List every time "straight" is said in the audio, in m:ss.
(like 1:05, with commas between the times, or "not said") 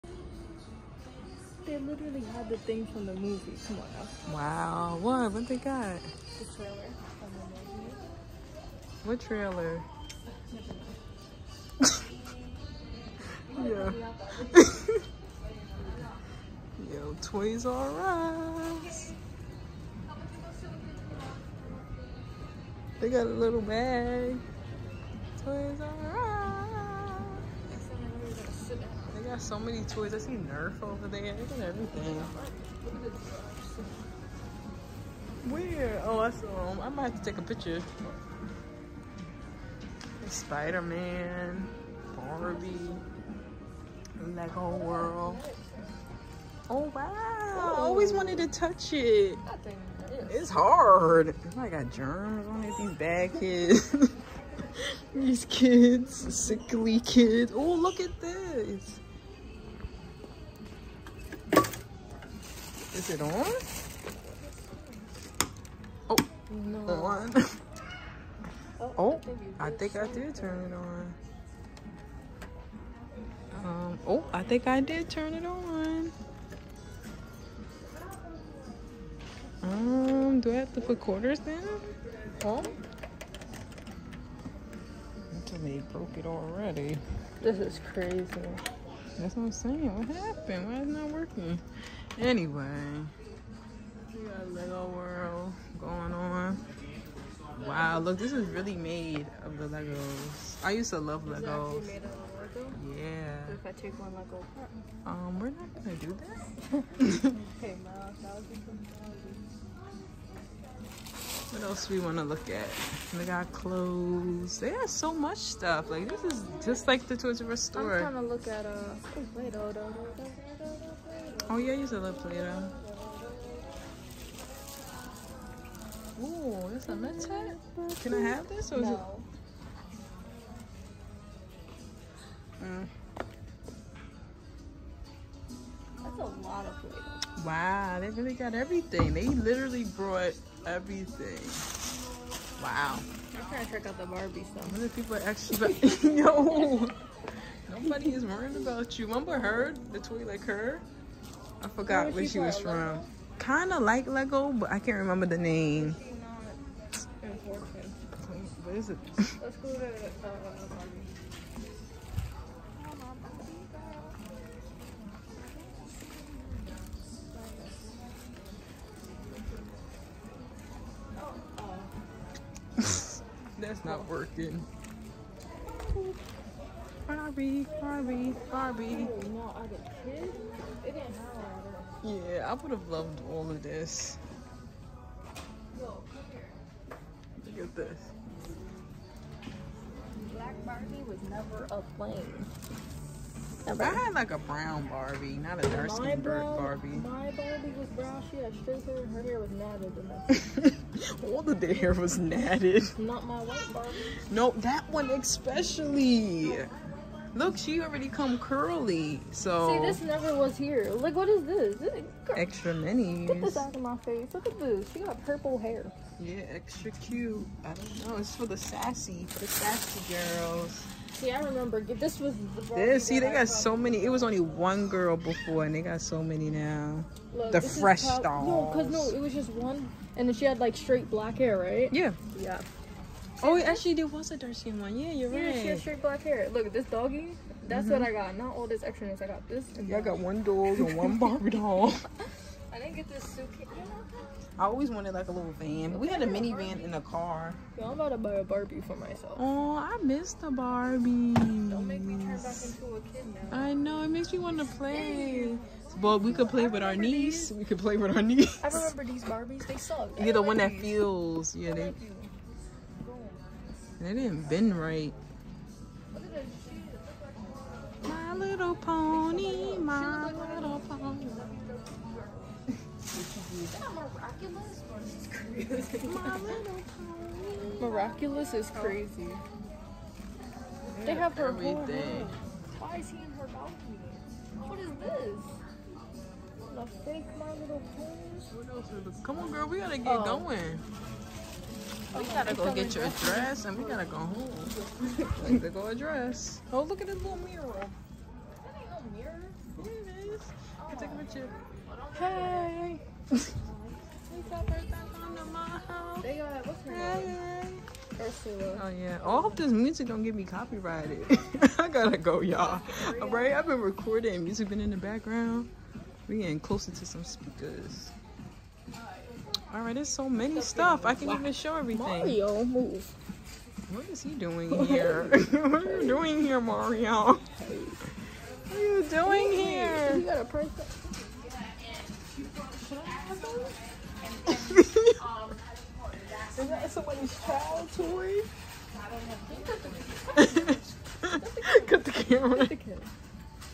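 3:18, 3:50, 3:55.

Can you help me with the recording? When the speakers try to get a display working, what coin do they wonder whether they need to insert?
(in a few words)
Quarters.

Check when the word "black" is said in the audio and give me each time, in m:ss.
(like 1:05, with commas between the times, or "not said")
3:10, 3:51, 3:56.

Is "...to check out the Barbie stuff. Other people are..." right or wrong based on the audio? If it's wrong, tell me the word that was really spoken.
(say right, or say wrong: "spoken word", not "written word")
right.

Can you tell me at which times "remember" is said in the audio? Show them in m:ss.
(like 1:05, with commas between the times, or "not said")
2:29, 2:34, 3:41, 4:18.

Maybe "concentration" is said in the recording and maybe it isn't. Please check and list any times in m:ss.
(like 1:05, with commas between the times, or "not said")
not said.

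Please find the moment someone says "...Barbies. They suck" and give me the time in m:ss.
4:19.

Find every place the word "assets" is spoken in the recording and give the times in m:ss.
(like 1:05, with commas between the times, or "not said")
not said.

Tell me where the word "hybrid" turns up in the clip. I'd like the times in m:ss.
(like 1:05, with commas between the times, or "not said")
not said.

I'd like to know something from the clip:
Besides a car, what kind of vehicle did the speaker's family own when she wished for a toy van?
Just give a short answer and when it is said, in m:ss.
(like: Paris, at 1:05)
Minivan, at 4:06.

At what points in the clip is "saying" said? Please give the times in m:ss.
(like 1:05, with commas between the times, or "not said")
1:29.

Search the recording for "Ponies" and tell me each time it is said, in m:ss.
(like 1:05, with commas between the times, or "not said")
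4:47.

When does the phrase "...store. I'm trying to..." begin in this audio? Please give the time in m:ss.
1:57.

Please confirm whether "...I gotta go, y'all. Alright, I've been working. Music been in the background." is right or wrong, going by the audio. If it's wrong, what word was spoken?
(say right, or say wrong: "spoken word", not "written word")
wrong: "recording", not "working".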